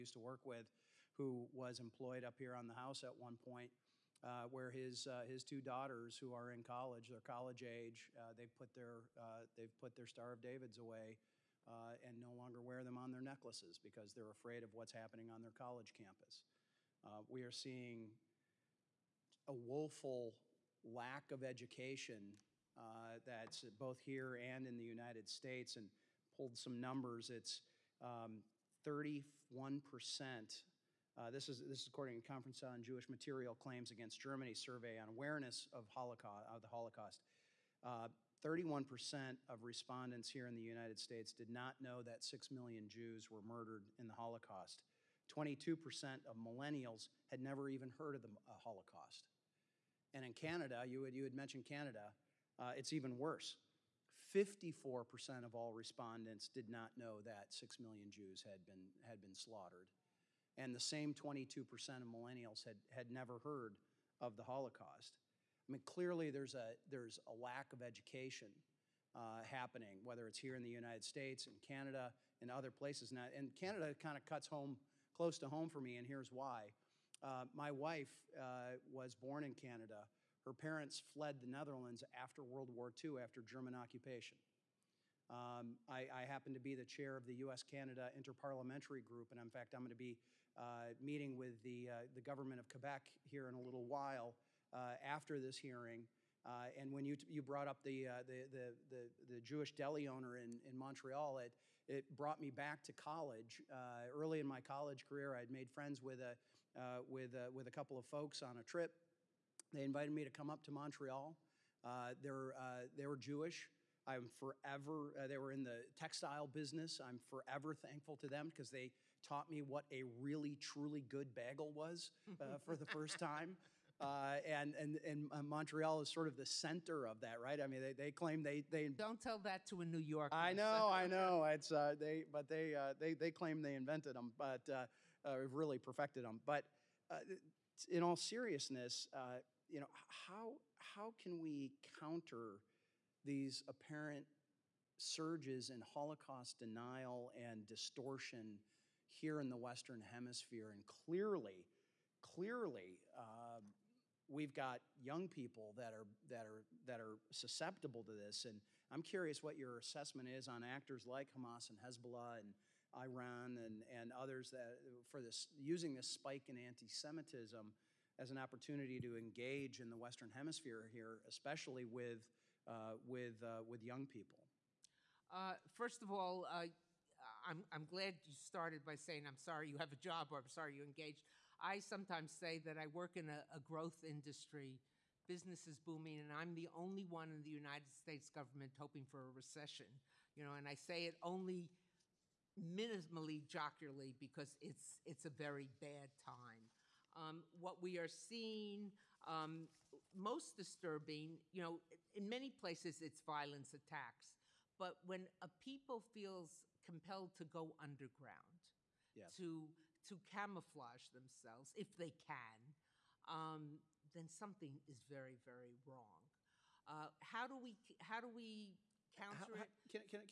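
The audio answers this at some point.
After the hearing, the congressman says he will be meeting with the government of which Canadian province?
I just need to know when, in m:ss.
1:32.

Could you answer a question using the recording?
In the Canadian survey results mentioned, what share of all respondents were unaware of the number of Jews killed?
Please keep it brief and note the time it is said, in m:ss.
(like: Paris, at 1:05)
54%, at 0:54.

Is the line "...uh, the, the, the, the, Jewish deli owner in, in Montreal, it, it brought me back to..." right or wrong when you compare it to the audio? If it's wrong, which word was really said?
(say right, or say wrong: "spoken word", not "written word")
right.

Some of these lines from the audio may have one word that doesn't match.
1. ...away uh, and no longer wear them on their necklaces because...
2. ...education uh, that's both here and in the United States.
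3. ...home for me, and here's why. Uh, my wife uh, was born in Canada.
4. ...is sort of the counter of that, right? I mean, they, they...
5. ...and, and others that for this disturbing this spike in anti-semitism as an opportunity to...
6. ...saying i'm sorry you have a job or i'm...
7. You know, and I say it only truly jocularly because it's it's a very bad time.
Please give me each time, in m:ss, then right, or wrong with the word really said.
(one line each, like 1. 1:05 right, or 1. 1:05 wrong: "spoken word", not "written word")
1. 0:10 right
2. 0:21 right
3. 1:15 right
4. 2:06 wrong: "center", not "counter"
5. 2:43 wrong: "using", not "disturbing"
6. 2:58 right
7. 3:10 wrong: "minimally", not "truly".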